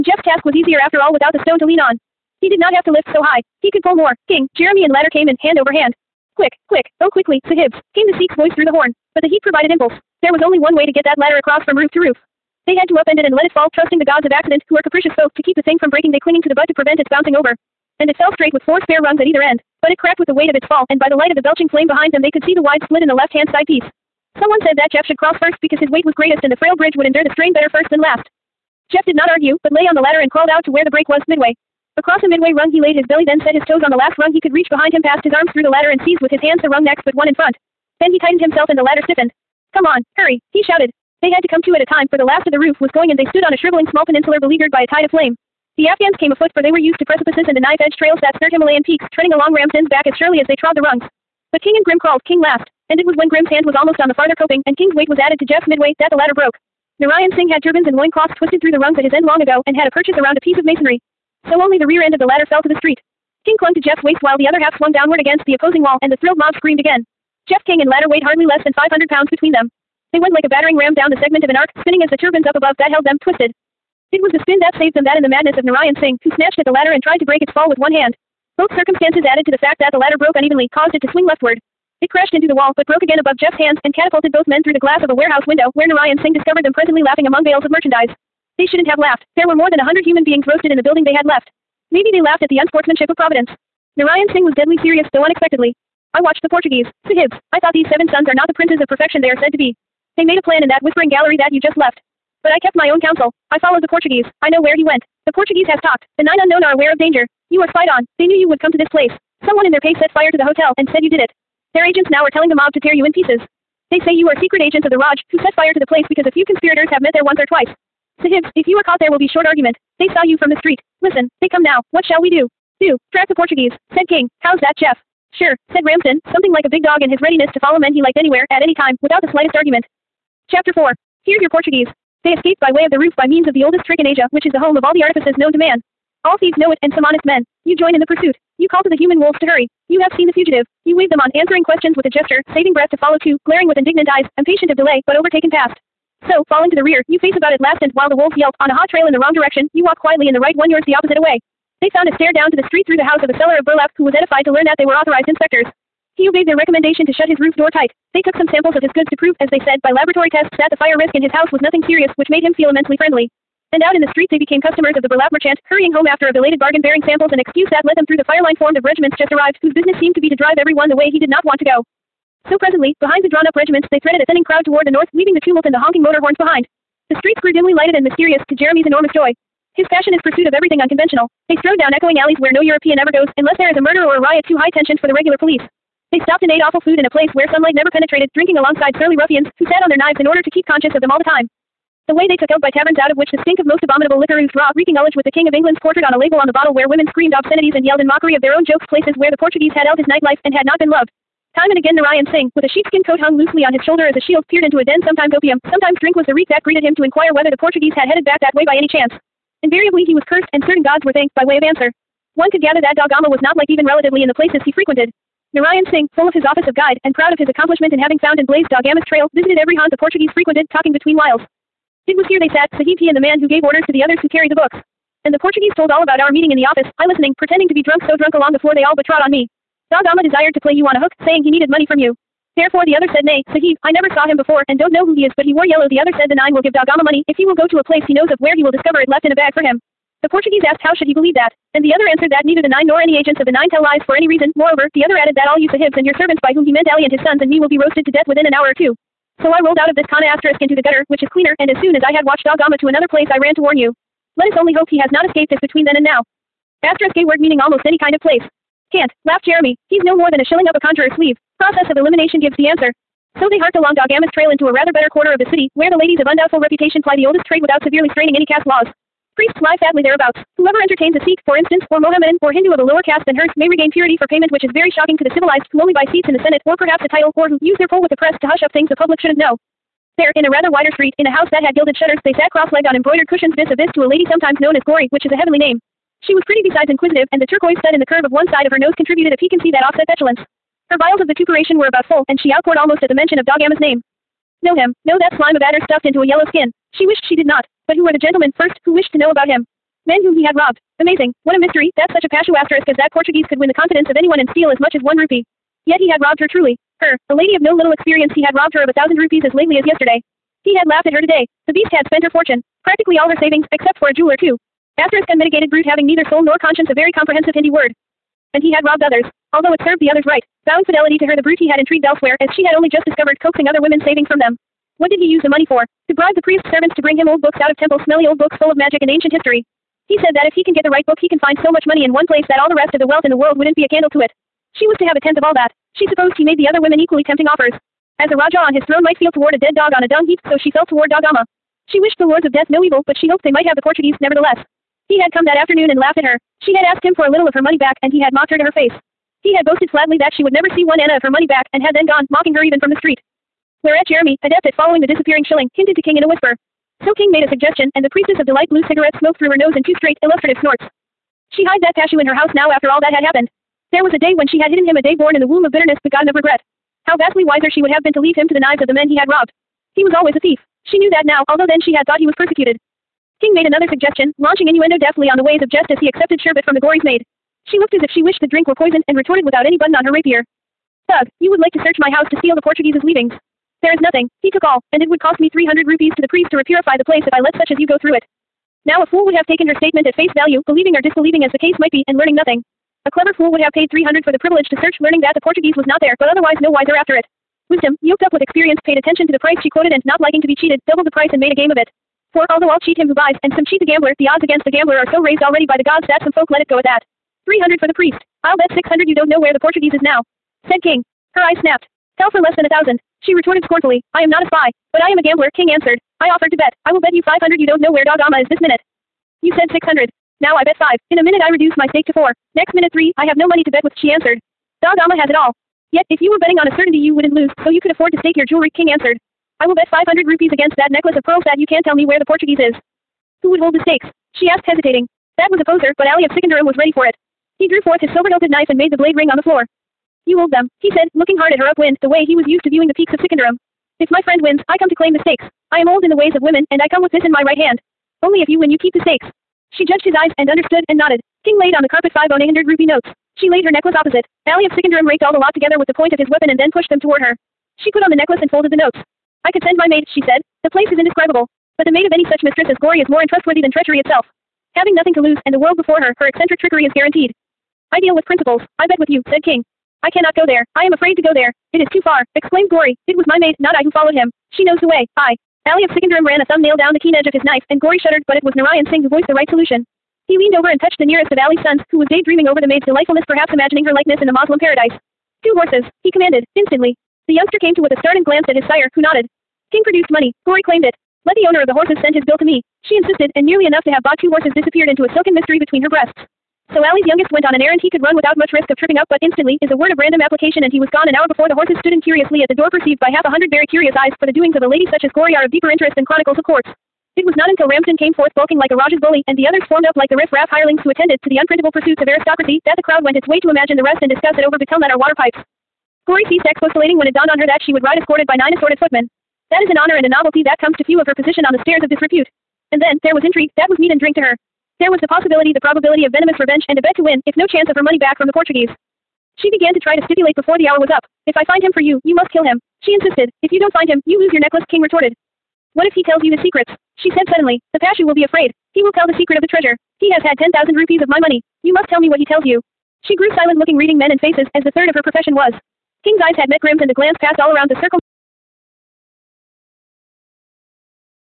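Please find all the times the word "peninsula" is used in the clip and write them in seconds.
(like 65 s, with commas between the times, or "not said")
44 s.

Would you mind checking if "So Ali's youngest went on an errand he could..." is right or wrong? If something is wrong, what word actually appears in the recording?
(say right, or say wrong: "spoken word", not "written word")
right.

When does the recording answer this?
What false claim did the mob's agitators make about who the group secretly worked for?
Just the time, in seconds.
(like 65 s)
114 s.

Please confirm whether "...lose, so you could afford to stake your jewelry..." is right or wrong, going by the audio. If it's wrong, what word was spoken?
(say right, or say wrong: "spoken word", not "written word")
right.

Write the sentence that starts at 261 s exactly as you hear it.
Process of elimination gives the answer.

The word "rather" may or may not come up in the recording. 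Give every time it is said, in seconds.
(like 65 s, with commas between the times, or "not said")
264 s, 280 s.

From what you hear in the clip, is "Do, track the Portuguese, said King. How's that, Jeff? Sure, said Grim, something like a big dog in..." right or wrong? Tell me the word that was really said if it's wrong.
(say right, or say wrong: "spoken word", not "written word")
wrong: "Ramsden", not "Grim".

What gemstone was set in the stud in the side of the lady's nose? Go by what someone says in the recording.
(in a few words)
turquoise.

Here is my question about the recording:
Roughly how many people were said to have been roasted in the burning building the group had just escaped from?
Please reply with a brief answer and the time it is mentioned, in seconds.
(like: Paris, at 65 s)
more than a hundred, at 89 s.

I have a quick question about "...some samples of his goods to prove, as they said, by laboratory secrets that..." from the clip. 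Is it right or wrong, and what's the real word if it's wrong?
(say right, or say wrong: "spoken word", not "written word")
wrong: "tests", not "secrets".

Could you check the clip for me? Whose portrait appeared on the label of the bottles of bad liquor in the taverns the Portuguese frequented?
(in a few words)
King of England.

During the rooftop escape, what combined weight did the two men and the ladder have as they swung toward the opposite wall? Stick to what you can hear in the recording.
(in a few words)
500 pounds.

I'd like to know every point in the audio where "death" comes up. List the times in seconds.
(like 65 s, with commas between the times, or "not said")
248 s, 342 s.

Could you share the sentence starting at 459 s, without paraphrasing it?
I could send my maid, she said.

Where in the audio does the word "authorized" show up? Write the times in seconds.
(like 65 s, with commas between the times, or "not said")
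154 s.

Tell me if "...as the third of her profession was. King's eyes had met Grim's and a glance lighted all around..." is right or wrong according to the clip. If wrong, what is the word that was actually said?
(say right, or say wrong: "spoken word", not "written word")
wrong: "passed", not "lighted".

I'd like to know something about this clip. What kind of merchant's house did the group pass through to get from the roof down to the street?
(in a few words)
seller of burlap.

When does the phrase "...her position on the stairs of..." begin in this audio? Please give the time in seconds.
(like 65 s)
521 s.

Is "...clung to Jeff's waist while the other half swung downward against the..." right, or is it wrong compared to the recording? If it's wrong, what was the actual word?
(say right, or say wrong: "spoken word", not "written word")
right.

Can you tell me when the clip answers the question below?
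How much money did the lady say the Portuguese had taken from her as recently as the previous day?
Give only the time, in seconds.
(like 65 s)
308 s.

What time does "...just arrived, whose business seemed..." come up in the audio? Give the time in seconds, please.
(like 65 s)
169 s.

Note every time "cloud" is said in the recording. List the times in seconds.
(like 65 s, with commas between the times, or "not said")
not said.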